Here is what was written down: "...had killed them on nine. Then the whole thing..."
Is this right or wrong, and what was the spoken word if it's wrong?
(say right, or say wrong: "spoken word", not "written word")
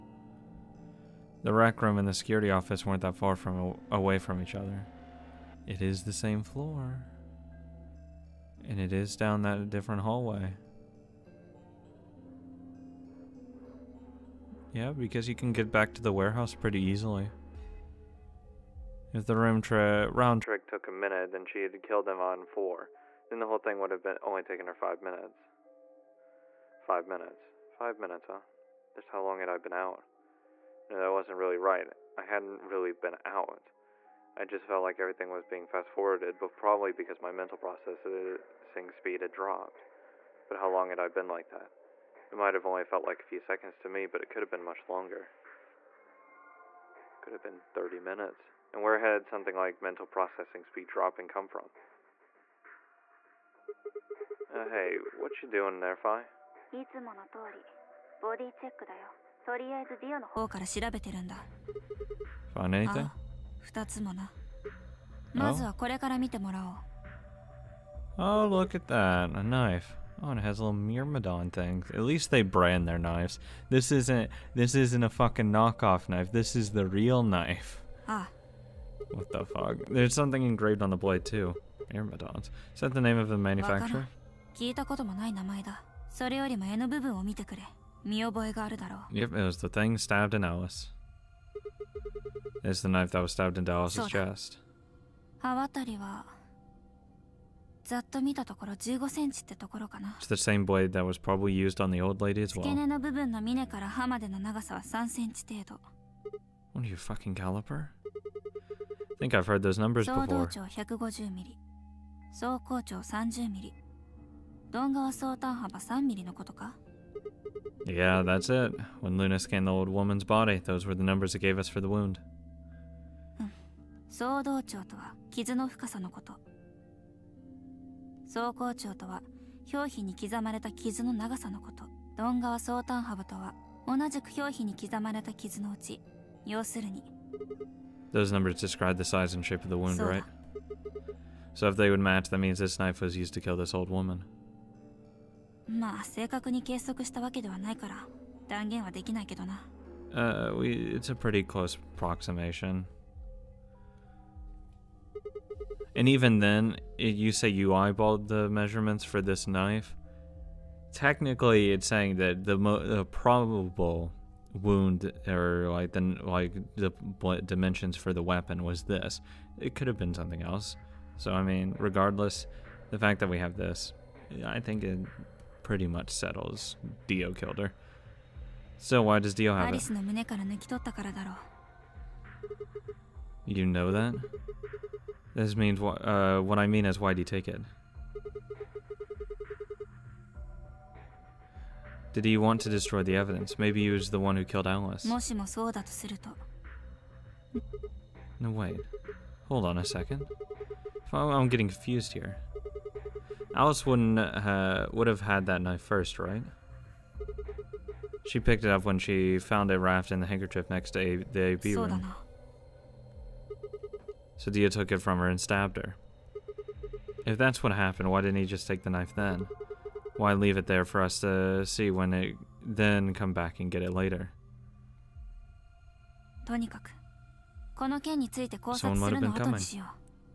wrong: "four", not "nine".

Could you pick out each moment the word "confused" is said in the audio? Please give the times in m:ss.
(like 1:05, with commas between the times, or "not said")
3:21.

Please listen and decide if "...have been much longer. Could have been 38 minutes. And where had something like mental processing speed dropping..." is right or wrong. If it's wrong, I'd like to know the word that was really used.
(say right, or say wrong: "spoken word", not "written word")
wrong: "30", not "38".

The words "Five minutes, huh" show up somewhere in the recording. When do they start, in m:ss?
0:27.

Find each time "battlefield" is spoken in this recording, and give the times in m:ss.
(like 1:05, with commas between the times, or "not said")
not said.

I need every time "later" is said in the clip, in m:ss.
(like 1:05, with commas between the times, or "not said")
3:43.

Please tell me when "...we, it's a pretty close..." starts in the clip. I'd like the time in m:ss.
2:30.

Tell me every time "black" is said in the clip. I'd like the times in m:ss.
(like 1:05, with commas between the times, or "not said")
not said.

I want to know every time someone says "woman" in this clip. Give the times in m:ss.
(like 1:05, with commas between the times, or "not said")
1:59, 2:23.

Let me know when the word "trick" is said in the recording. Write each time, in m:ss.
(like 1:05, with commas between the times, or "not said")
0:20.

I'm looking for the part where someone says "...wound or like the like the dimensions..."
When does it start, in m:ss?
2:44.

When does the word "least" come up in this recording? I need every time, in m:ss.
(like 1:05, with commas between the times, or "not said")
1:12.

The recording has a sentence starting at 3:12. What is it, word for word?
Did he want to destroy the evidence?